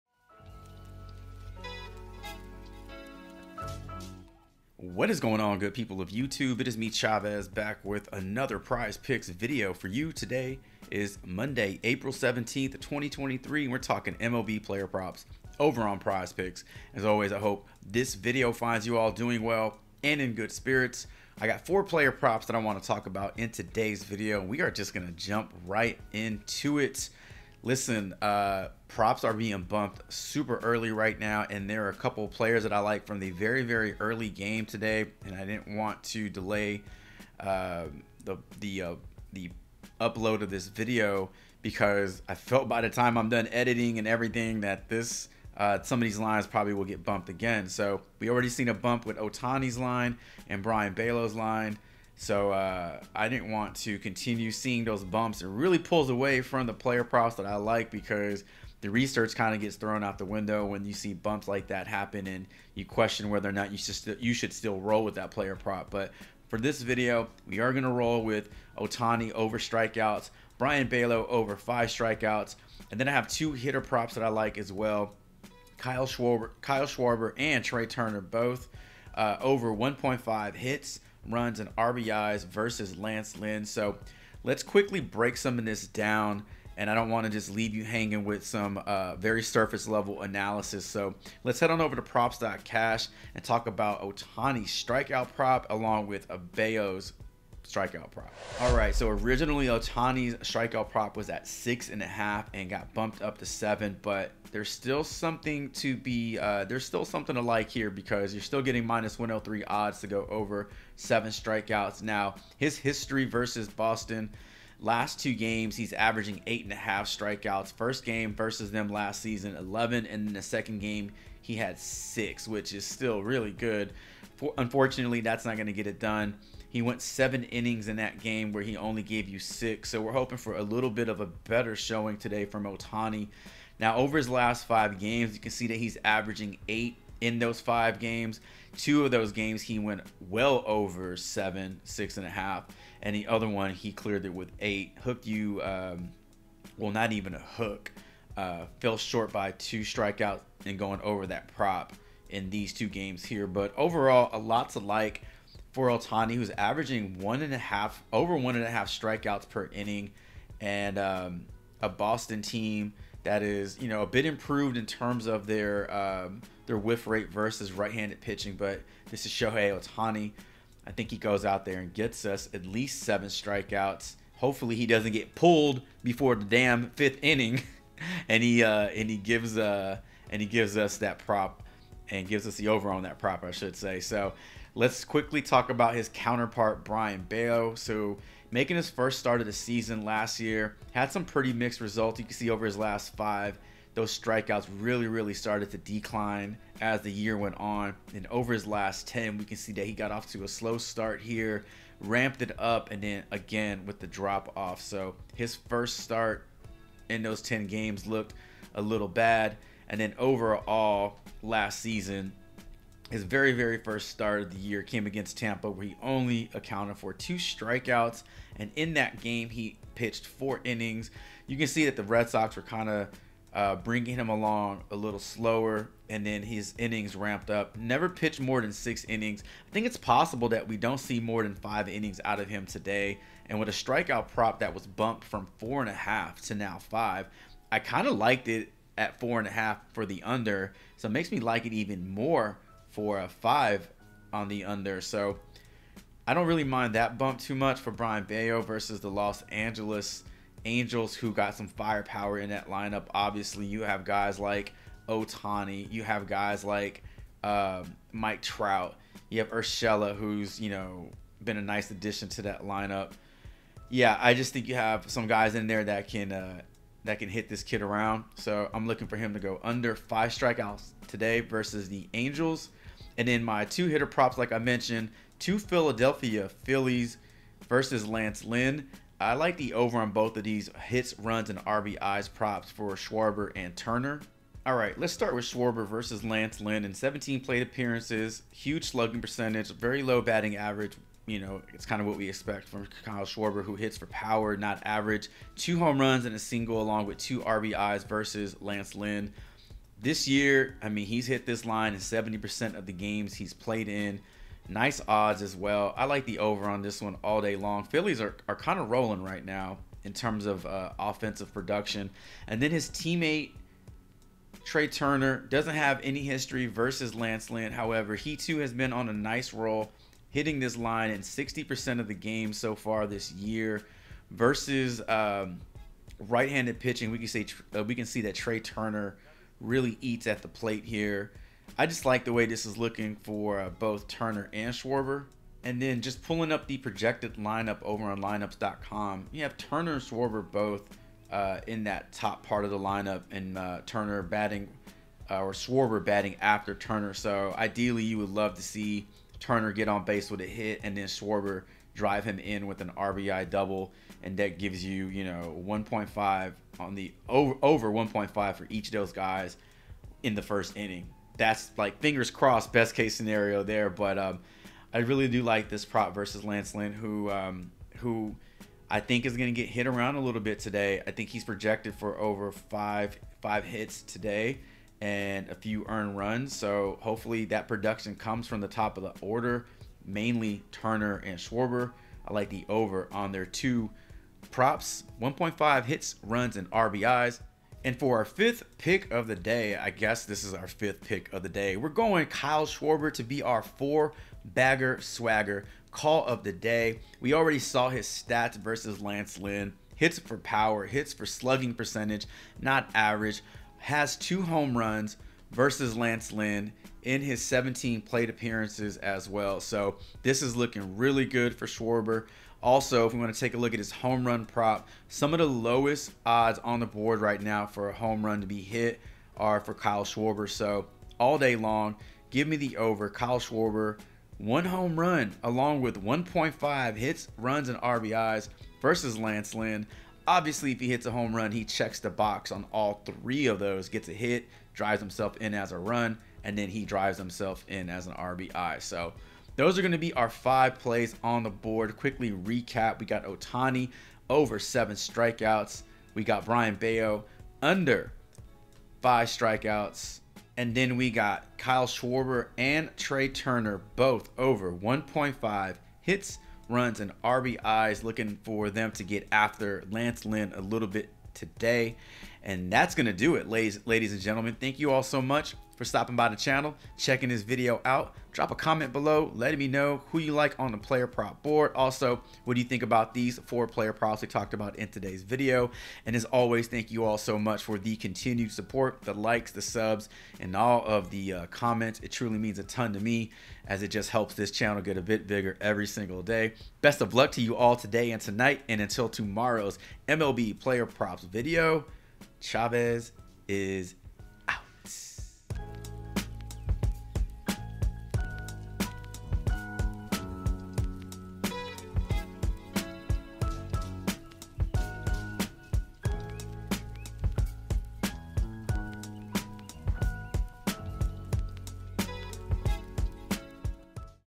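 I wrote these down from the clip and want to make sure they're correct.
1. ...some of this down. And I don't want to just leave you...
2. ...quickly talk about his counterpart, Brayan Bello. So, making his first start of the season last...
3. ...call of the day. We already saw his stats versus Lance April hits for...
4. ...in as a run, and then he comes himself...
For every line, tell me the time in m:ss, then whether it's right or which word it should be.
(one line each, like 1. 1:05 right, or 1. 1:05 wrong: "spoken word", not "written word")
1. 1:25 right
2. 3:05 right
3. 6:35 wrong: "Lynn", not "April"
4. 7:15 wrong: "drives", not "comes".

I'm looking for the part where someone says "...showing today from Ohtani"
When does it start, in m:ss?
2:11.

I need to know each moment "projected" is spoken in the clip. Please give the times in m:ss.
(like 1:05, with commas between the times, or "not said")
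5:36, 6:11.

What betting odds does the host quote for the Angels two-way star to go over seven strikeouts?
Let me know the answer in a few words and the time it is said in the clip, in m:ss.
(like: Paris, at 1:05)
-103, at 1:48.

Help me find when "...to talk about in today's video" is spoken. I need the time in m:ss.
0:22.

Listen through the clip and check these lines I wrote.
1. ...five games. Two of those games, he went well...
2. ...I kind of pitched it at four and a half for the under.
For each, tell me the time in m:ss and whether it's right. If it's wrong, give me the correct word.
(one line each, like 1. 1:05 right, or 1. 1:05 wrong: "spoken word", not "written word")
1. 2:17 right
2. 3:57 wrong: "liked", not "pitched".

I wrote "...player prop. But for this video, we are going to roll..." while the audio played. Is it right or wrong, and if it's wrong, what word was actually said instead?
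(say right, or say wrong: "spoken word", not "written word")
right.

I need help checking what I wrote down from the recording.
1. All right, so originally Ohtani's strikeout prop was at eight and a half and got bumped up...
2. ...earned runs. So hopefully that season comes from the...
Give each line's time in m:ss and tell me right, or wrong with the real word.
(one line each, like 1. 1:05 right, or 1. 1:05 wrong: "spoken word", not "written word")
1. 1:38 wrong: "six", not "eight"
2. 6:15 wrong: "production", not "season".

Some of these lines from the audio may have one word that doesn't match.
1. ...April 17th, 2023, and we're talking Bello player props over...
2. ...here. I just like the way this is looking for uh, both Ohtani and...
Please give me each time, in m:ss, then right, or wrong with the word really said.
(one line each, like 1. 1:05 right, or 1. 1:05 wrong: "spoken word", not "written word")
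1. 0:11 wrong: "MLB", not "Bello"
2. 5:30 wrong: "Turner", not "Ohtani".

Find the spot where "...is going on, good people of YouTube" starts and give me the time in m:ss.
0:05.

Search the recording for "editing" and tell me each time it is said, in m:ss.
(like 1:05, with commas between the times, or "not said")
0:43.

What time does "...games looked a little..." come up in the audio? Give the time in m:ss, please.
3:27.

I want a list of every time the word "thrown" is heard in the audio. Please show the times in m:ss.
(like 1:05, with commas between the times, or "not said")
0:59.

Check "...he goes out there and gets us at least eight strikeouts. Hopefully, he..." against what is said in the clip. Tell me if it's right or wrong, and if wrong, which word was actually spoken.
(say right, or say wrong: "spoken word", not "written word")
wrong: "seven", not "eight".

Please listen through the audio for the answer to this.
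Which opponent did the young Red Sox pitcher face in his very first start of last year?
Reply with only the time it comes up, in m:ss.
3:35.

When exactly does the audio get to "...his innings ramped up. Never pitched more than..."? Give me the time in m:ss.
3:46.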